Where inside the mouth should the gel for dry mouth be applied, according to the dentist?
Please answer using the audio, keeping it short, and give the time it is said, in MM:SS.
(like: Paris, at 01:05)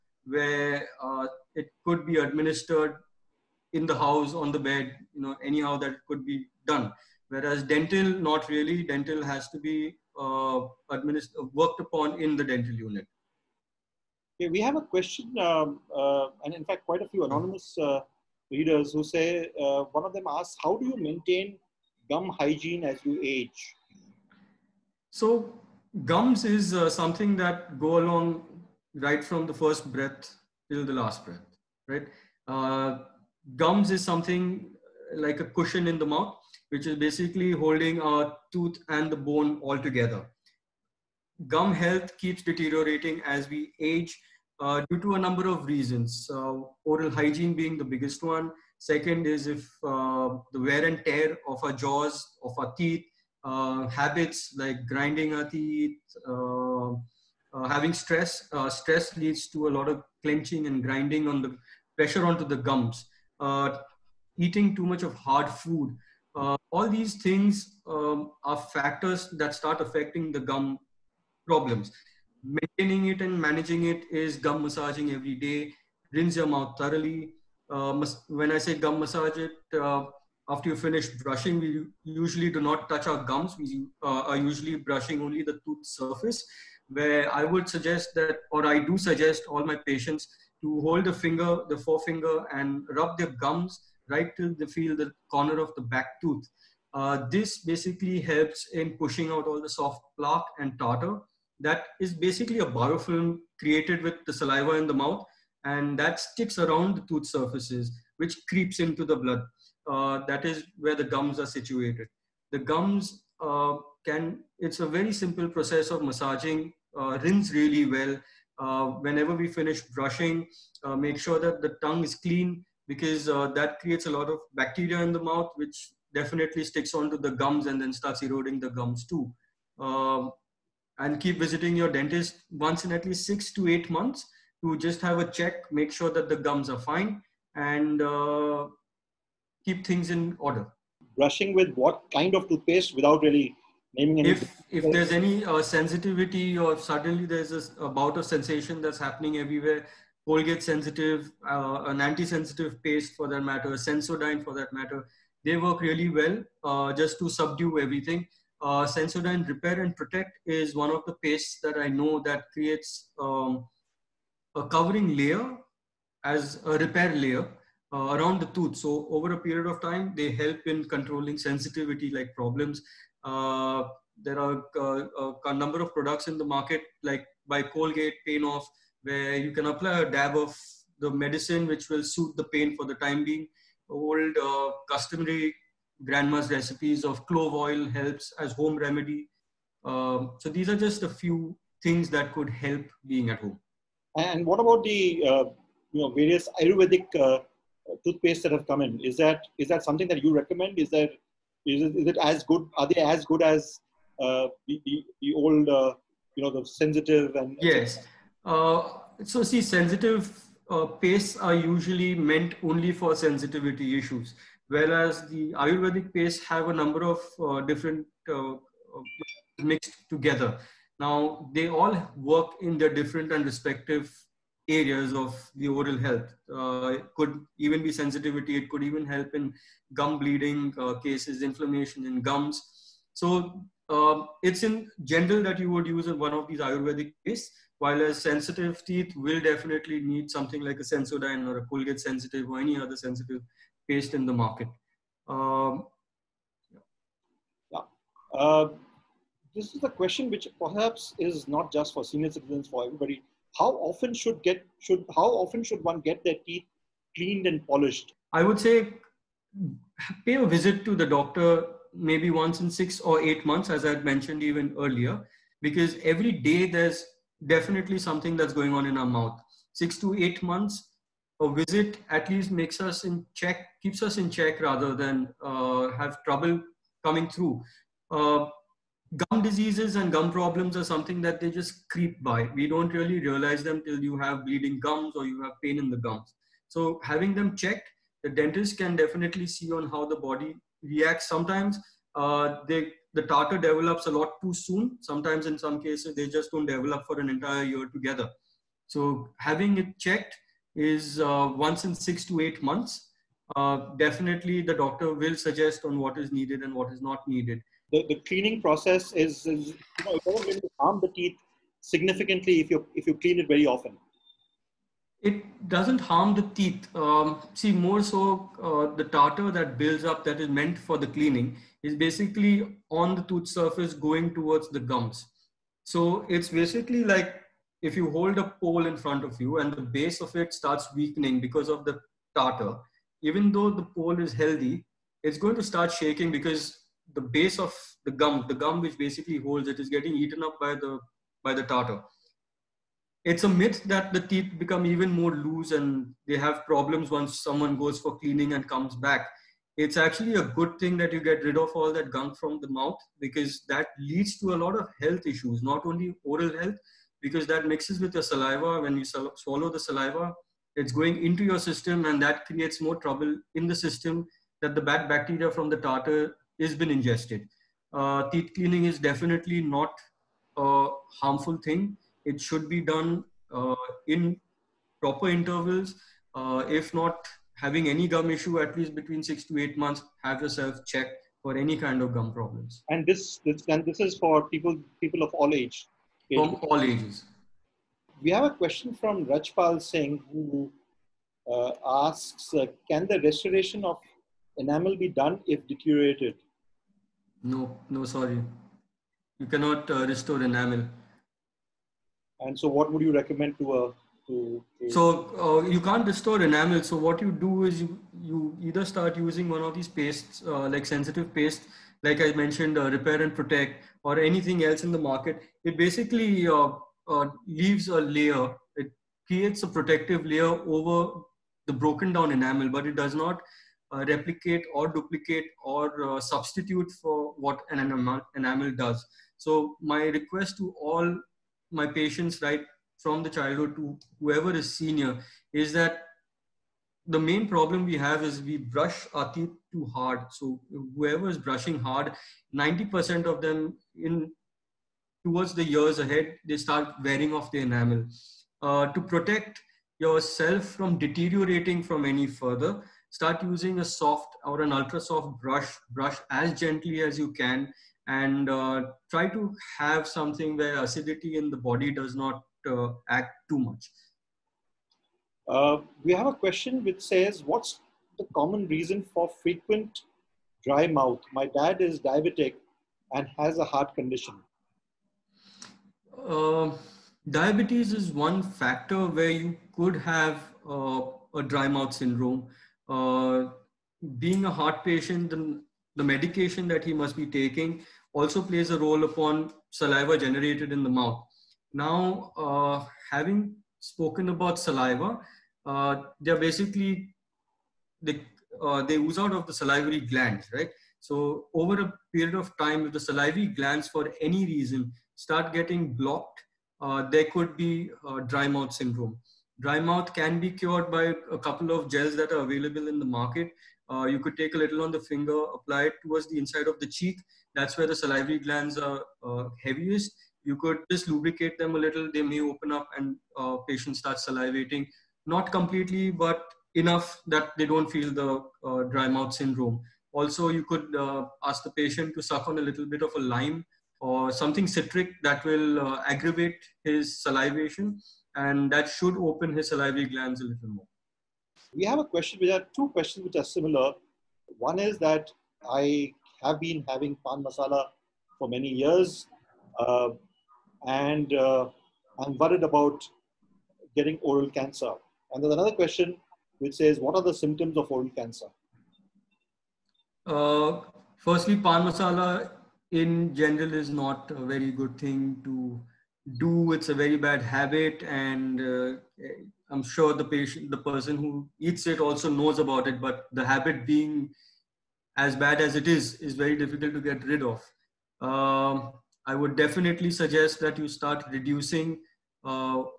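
Inside of the cheek, at 08:36.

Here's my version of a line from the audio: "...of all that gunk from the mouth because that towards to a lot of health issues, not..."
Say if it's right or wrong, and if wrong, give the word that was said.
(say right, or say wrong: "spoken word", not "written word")
wrong: "leads", not "towards".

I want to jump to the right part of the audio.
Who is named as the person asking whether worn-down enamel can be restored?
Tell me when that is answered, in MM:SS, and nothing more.
06:29.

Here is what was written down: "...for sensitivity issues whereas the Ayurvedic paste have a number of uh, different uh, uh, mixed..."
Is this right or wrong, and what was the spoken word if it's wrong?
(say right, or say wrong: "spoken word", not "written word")
right.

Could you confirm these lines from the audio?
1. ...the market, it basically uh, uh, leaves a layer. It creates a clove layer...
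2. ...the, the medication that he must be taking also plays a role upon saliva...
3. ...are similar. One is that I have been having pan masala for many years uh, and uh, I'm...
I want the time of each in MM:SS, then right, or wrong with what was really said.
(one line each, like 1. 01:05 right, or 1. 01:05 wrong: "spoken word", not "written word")
1. 06:54 wrong: "protective", not "clove"
2. 08:05 right
3. 09:03 right.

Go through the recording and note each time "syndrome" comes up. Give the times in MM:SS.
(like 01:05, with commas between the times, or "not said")
08:01, 08:28, 08:49.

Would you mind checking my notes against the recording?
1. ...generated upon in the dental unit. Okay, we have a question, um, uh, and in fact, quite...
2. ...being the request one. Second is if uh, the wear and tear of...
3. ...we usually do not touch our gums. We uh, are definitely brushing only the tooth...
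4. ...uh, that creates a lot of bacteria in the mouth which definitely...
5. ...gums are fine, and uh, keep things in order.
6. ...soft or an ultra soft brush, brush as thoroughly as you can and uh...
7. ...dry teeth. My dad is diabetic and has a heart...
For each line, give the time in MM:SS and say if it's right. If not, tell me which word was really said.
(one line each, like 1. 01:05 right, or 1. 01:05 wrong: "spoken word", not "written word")
1. 00:11 wrong: "worked", not "generated"
2. 00:47 wrong: "biggest", not "request"
3. 01:21 wrong: "usually", not "definitely"
4. 02:03 right
5. 02:16 right
6. 07:33 wrong: "gently", not "thoroughly"
7. 07:50 wrong: "mouth", not "teeth".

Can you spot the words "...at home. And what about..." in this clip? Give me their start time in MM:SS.
03:13.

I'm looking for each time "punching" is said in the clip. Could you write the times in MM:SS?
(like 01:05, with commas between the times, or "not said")
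not said.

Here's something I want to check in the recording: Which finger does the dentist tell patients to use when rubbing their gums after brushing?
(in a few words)
Forefinger.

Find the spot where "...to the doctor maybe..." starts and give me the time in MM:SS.
04:20.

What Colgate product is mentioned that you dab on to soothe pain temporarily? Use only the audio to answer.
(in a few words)
Pain Off.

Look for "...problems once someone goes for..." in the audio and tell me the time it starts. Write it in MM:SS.
05:46.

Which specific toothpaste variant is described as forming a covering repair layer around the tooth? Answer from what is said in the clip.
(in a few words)
Sensodyne Repair and Protect.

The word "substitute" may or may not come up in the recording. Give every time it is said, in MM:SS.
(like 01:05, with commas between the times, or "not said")
07:06.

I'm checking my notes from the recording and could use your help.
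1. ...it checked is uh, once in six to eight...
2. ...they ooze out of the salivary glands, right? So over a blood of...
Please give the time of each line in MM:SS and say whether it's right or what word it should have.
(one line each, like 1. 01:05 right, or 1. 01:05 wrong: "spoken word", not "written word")
1. 04:59 right
2. 08:18 wrong: "period", not "blood".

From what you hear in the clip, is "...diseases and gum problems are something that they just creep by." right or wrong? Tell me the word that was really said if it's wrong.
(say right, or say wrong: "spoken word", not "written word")
right.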